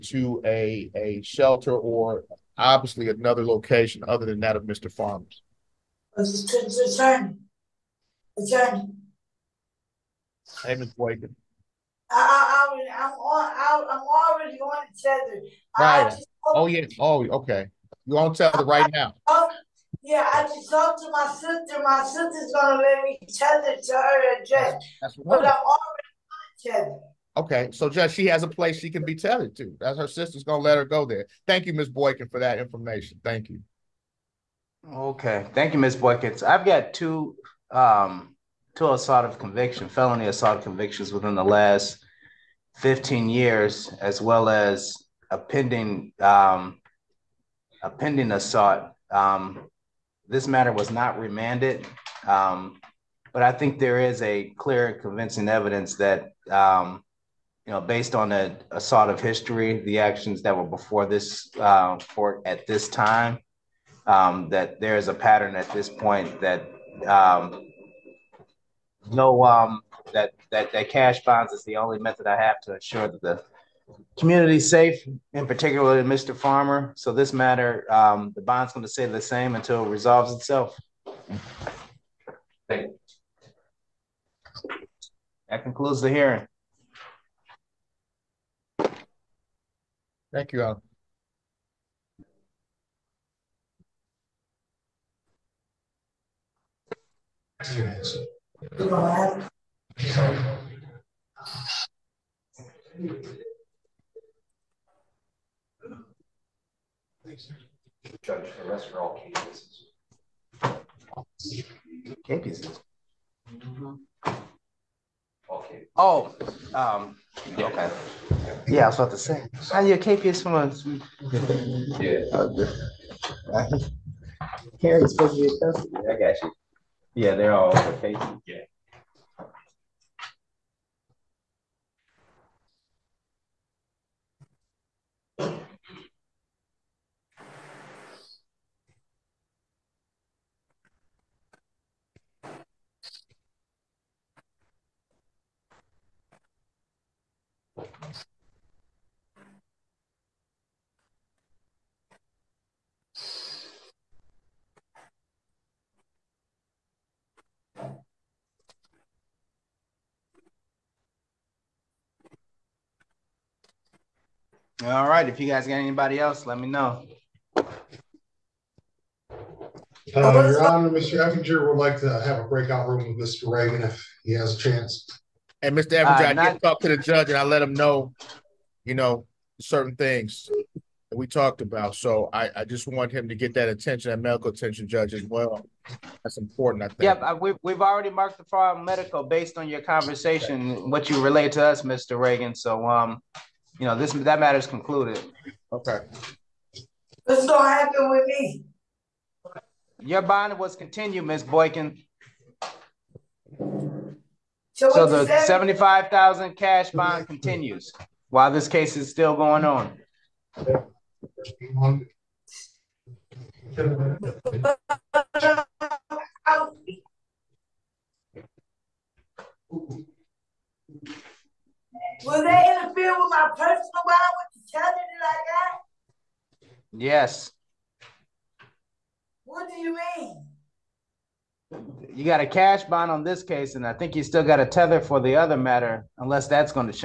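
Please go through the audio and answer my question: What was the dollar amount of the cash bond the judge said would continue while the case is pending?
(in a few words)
$75,000.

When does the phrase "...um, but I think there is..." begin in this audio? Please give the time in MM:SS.
00:52.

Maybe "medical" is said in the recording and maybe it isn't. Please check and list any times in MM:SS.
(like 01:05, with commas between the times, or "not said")
03:04, 03:08.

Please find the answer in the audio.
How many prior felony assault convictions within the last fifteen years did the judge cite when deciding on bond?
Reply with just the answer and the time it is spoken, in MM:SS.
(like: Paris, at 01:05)
2, at 00:38.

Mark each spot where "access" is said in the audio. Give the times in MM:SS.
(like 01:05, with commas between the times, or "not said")
not said.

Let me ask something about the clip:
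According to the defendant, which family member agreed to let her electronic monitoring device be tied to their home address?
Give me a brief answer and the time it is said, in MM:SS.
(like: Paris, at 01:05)
Her sister, at 00:21.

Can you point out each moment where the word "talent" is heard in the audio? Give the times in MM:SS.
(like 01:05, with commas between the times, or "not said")
03:44.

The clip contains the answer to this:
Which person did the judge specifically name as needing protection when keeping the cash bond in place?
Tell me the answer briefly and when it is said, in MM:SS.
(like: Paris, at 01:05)
Mr. Farmer, at 01:15.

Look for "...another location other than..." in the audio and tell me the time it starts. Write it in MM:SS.
00:03.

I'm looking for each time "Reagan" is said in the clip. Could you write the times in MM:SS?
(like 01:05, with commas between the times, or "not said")
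02:53, 03:12.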